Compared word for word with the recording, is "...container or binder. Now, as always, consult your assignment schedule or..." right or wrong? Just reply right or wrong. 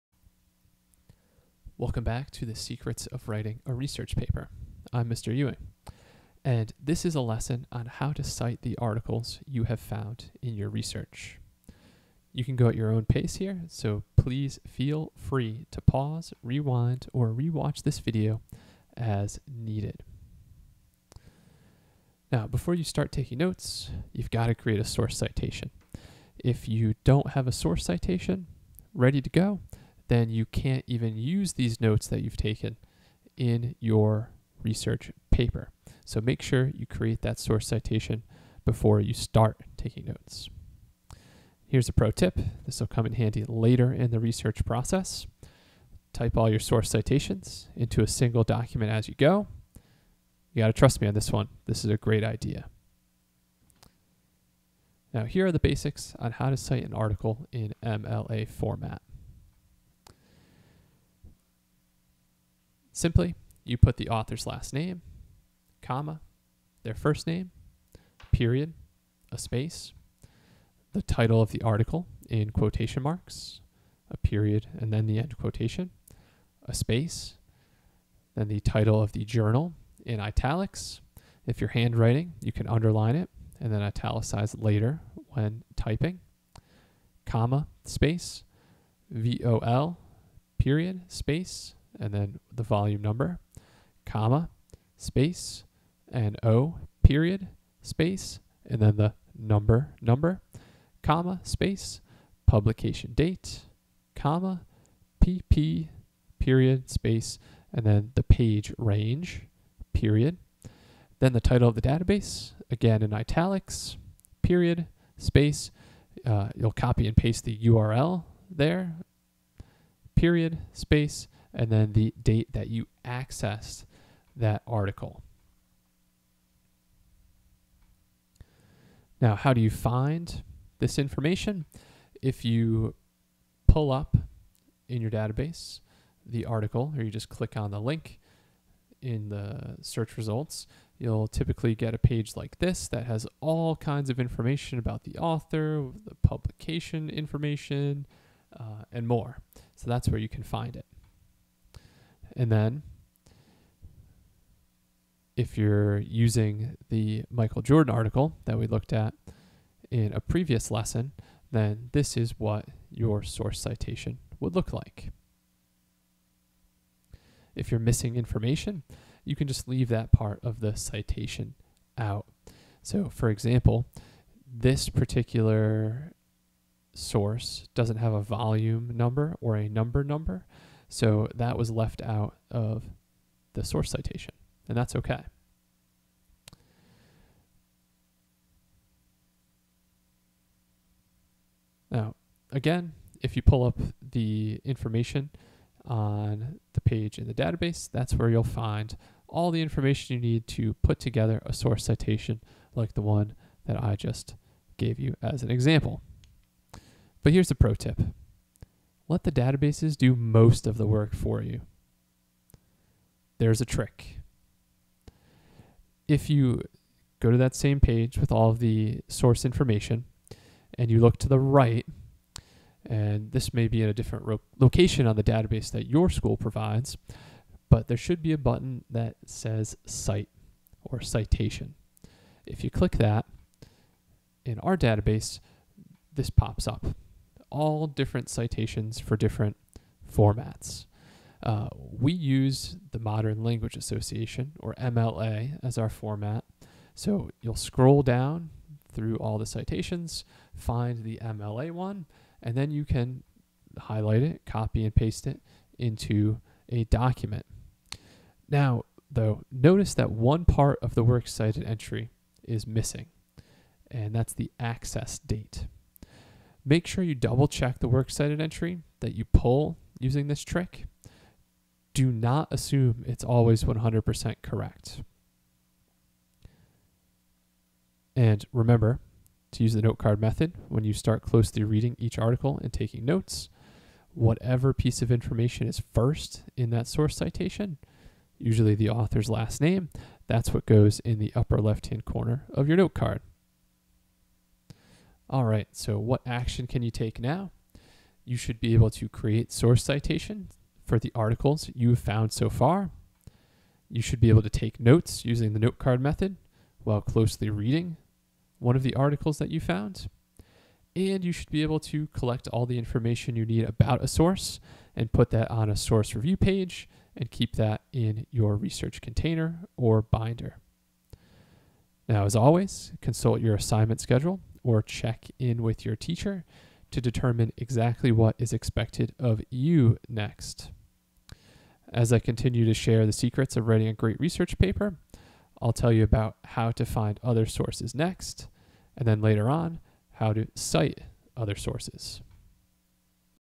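right.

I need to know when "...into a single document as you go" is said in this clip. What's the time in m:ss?
0:47.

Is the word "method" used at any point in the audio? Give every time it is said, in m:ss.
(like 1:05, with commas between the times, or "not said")
4:40, 5:06.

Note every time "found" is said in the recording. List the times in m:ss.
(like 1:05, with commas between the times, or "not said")
0:09, 5:01, 5:09.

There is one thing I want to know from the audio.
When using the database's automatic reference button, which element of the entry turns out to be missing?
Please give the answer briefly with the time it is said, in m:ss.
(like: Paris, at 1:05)
the access date, at 4:24.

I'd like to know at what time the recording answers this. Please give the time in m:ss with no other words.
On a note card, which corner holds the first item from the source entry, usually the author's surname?
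4:51.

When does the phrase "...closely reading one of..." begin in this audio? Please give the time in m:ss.
5:06.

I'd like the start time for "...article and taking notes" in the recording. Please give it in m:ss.
4:42.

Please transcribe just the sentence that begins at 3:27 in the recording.
But here's a pro tip let the databases do most of the work for you.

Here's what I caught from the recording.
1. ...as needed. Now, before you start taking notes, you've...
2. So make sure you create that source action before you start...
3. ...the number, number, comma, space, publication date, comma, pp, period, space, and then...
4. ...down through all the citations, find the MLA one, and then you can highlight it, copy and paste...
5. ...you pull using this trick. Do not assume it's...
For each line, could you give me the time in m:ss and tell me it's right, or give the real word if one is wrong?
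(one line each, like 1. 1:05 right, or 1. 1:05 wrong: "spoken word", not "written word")
1. 0:18 right
2. 0:36 wrong: "citation", not "action"
3. 1:38 right
4. 4:08 right
5. 4:29 right.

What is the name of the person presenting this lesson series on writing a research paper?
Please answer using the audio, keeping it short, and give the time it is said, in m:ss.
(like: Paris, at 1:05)
Mr. Ewing, at 0:05.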